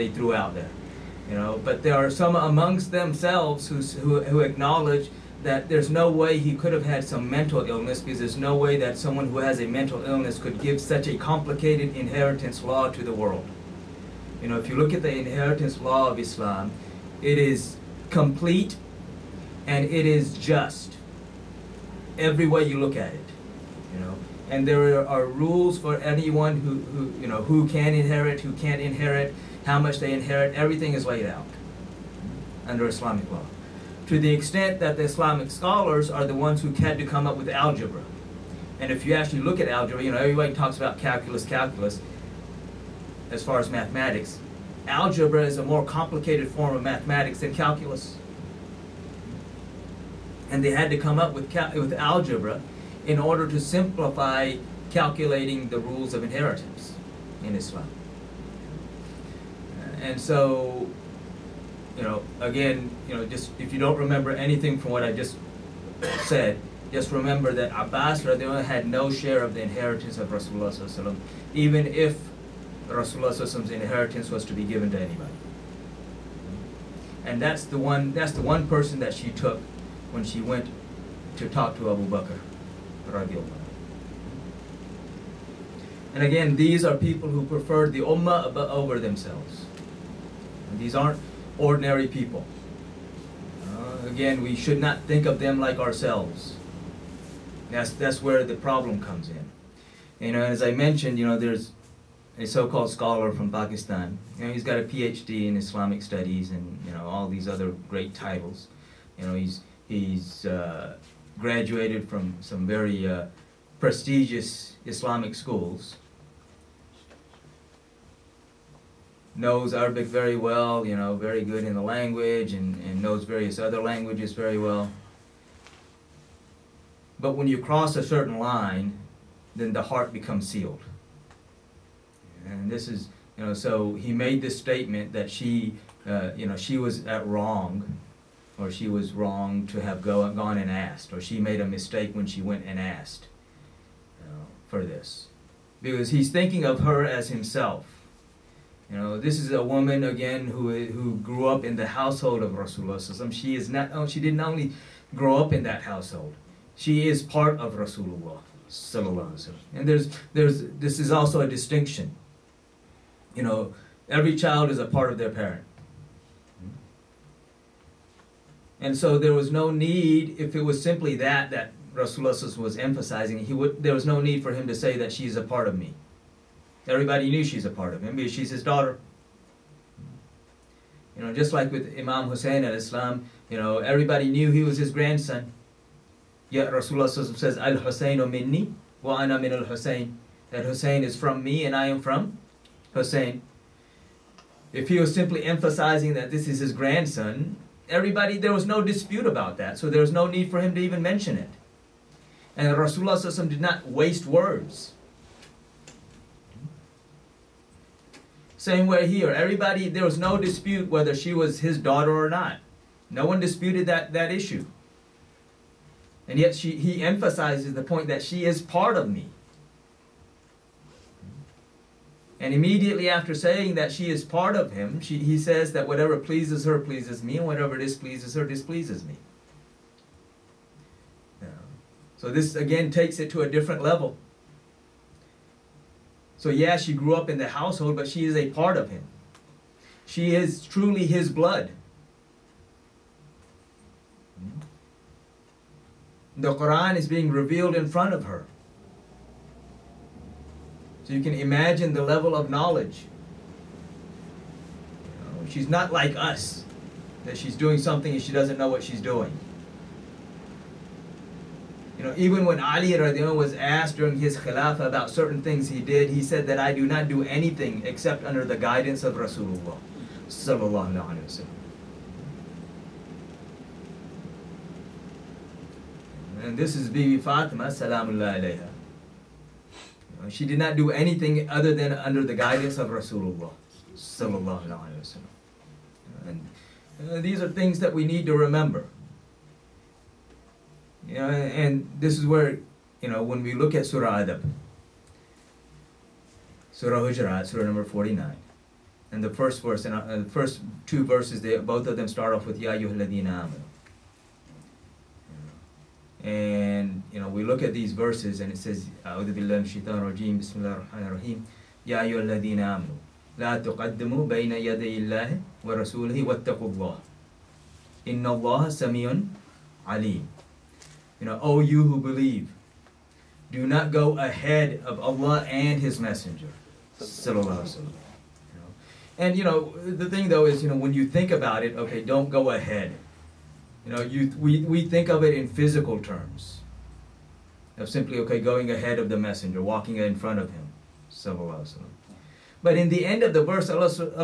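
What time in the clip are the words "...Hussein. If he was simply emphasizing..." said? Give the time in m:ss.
3:12.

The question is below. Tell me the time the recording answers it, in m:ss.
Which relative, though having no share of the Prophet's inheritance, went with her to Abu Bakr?
1:07.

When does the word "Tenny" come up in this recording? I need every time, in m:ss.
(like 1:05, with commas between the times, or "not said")
not said.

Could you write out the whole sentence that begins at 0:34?
To the extent that the Islamic scholars are the ones who had to come up with algebra.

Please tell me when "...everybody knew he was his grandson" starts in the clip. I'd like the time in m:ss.
3:03.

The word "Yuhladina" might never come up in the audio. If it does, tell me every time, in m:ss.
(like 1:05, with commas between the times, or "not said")
5:02, 5:12.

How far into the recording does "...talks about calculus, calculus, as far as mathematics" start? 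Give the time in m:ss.
0:40.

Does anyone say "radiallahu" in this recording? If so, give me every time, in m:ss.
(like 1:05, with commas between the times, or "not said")
1:08, 1:23, 4:22.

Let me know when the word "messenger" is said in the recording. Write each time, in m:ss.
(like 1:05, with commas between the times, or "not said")
5:25, 5:39.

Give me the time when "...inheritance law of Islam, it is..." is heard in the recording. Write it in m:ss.
0:15.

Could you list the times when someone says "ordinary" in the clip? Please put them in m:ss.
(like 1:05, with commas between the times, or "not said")
1:31.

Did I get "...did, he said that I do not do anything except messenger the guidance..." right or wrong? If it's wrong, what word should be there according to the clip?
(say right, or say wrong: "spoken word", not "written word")
wrong: "under", not "messenger".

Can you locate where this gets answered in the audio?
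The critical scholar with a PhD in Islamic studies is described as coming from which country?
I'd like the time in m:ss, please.
1:43.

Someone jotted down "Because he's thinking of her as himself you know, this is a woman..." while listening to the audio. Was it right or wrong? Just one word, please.
right.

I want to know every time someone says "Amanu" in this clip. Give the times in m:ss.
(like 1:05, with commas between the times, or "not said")
5:03, 5:12.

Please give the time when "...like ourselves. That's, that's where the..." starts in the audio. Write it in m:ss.
1:35.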